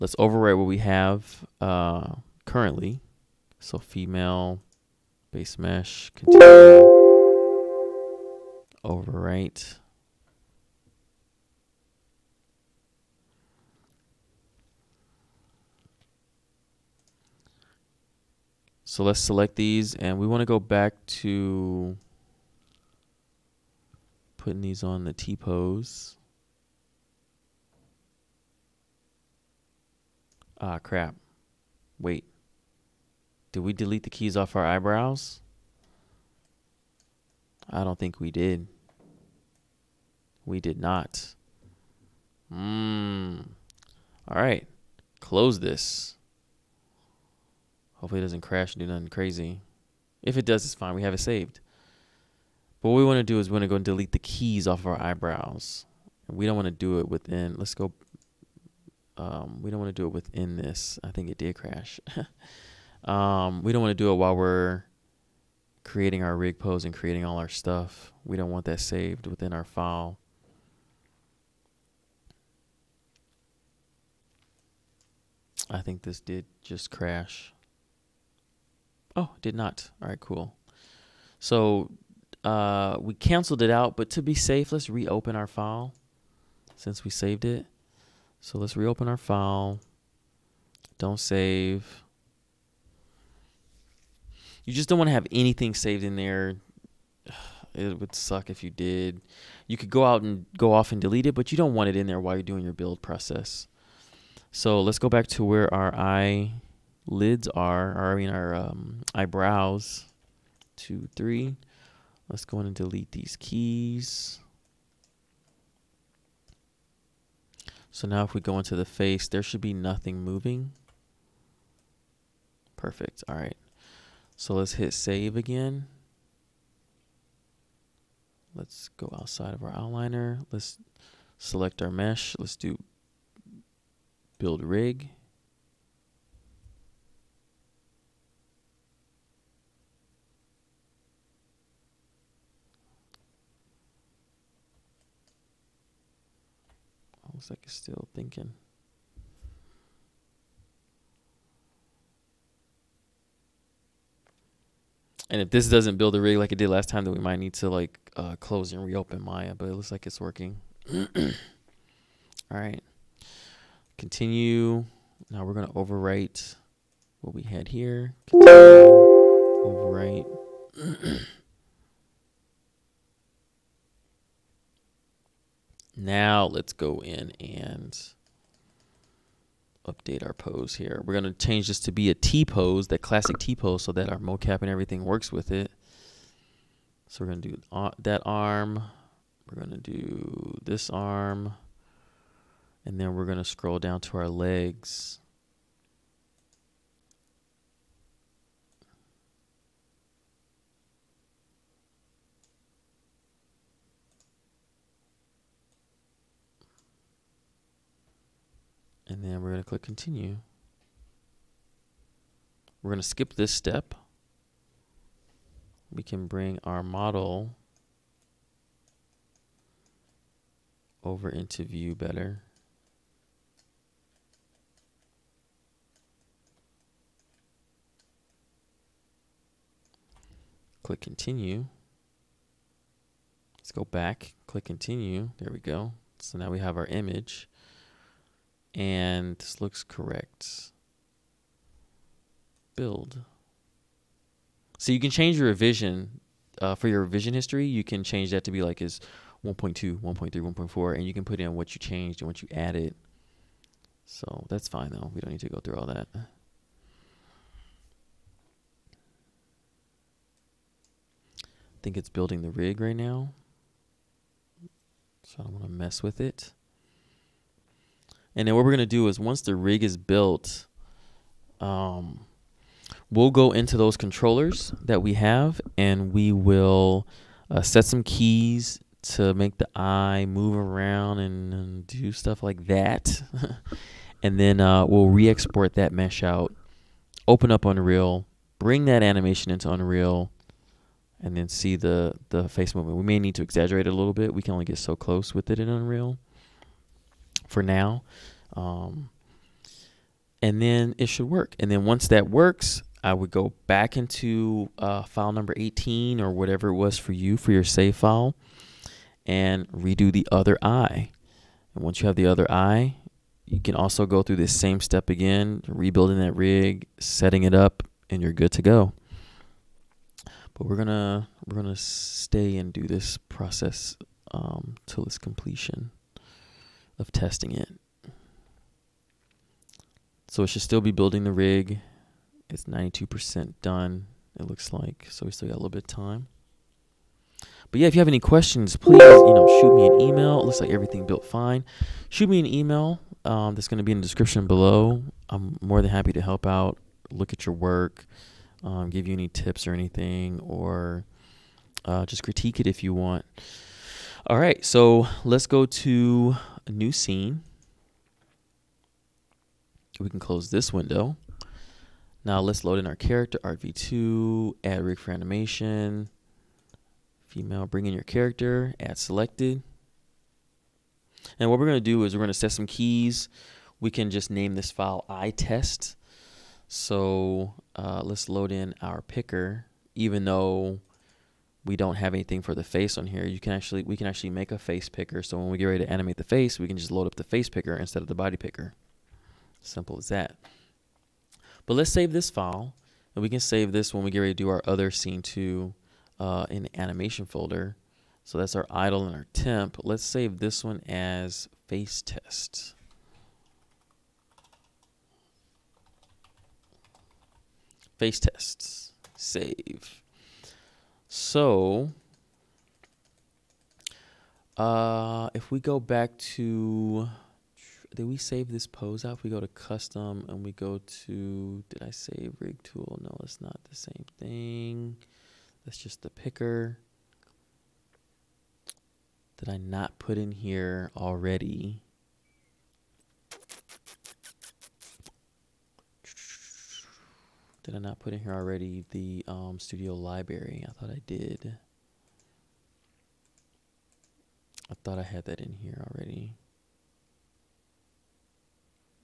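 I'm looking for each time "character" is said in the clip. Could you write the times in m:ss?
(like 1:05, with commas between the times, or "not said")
6:02, 6:08.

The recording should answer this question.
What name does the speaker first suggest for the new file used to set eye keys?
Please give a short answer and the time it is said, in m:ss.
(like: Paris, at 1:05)
iTest, at 6:15.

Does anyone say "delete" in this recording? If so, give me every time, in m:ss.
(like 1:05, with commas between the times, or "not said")
0:33, 0:53, 1:40, 1:52.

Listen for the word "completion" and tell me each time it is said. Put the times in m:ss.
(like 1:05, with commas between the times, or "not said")
5:25.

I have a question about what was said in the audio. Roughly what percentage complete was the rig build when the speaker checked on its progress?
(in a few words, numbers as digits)
92%.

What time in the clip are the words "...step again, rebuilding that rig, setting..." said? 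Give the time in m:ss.
5:14.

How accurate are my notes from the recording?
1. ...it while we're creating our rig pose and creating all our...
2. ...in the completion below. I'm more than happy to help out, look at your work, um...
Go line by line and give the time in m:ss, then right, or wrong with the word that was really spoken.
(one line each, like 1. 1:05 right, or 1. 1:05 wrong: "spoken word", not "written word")
1. 1:04 right
2. 5:43 wrong: "description", not "completion".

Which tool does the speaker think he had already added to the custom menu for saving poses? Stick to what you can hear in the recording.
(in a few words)
Studio library.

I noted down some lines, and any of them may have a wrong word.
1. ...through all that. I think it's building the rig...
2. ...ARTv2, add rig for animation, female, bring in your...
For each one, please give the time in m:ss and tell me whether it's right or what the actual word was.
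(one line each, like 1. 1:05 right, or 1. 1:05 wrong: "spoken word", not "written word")
1. 4:15 right
2. 6:03 right.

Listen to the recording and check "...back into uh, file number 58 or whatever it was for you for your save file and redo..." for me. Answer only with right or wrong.
wrong.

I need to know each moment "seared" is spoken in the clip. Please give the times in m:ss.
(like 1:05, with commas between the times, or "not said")
not said.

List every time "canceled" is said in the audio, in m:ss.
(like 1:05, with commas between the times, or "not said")
1:23.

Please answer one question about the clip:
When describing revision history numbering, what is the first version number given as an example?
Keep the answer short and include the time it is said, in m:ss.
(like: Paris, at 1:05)
1.2, at 4:09.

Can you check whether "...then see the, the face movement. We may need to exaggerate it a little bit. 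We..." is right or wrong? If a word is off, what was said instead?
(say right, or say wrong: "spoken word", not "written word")
right.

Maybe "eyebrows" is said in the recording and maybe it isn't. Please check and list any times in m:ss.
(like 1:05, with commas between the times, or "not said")
0:34, 0:54, 1:49.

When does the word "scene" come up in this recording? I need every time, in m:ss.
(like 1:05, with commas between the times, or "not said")
5:56, 6:34.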